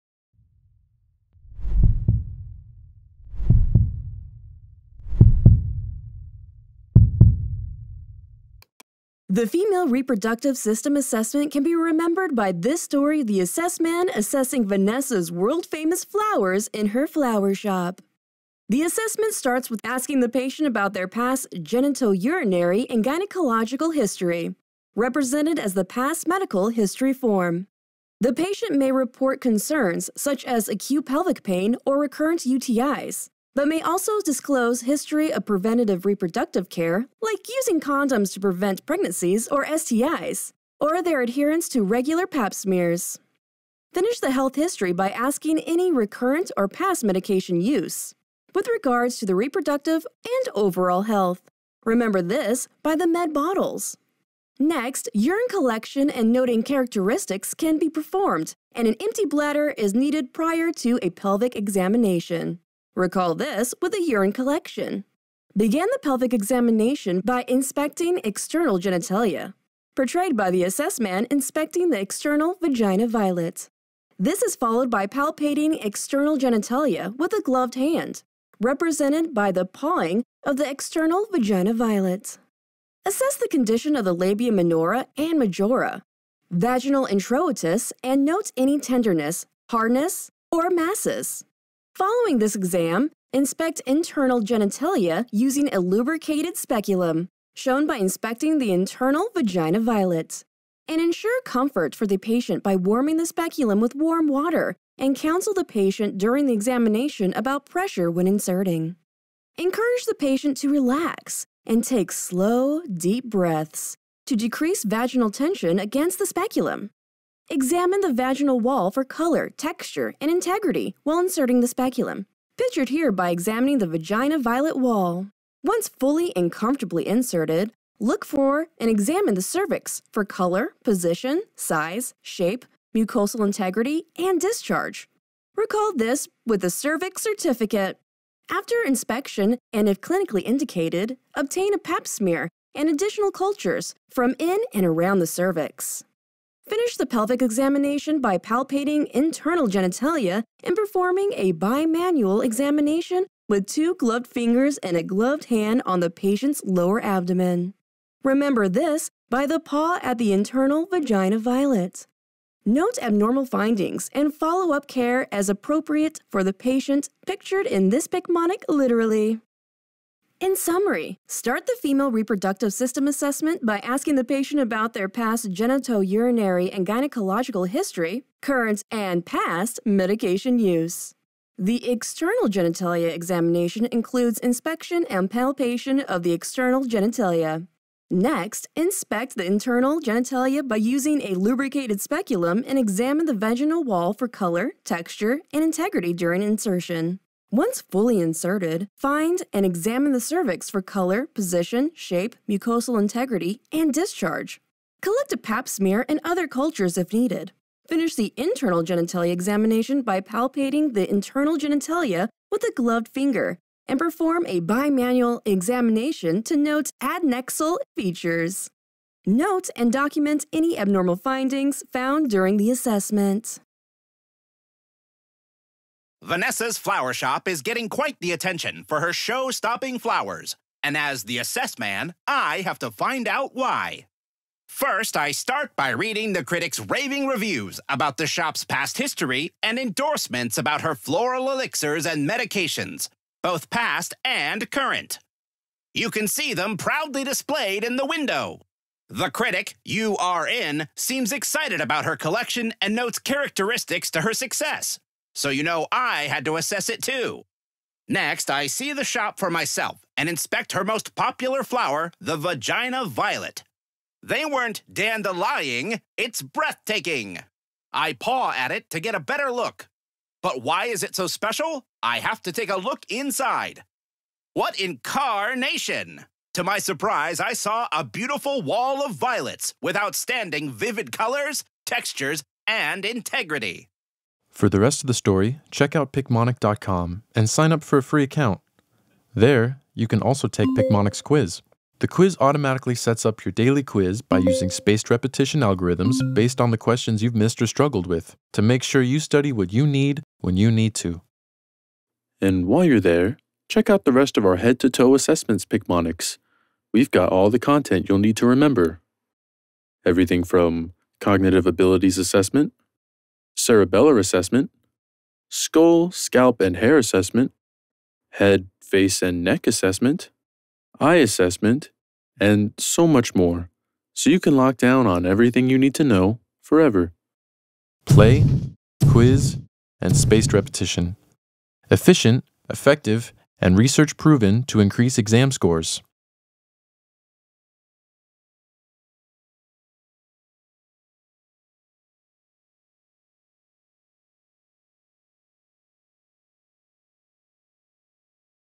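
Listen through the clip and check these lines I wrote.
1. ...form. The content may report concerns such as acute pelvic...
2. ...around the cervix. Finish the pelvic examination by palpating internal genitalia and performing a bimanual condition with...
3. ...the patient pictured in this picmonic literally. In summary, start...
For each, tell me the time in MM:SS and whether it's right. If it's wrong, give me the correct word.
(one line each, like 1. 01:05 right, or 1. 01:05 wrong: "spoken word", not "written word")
1. 00:27 wrong: "patient", not "content"
2. 02:24 wrong: "examination", not "condition"
3. 02:46 right.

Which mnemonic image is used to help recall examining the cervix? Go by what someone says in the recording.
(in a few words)
cervix certificate.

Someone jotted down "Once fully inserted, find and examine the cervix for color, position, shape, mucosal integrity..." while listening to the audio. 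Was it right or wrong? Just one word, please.
right.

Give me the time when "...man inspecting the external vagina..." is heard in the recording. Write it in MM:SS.
01:10.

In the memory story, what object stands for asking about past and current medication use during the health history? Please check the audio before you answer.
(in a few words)
med bottles.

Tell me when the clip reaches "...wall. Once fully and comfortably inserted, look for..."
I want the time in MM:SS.
02:04.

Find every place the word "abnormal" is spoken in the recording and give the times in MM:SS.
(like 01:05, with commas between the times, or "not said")
02:43, 03:40.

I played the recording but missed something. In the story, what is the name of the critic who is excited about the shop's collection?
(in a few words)
URN.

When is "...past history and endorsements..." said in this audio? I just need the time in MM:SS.
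03:58.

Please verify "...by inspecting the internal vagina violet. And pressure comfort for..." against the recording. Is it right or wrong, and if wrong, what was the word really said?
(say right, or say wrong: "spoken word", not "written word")
wrong: "ensure", not "pressure".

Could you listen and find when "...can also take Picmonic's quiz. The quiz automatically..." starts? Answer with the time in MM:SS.
04:50.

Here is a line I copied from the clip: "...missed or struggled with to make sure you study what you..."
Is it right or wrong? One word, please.
right.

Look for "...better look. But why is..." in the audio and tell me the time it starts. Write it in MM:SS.
04:29.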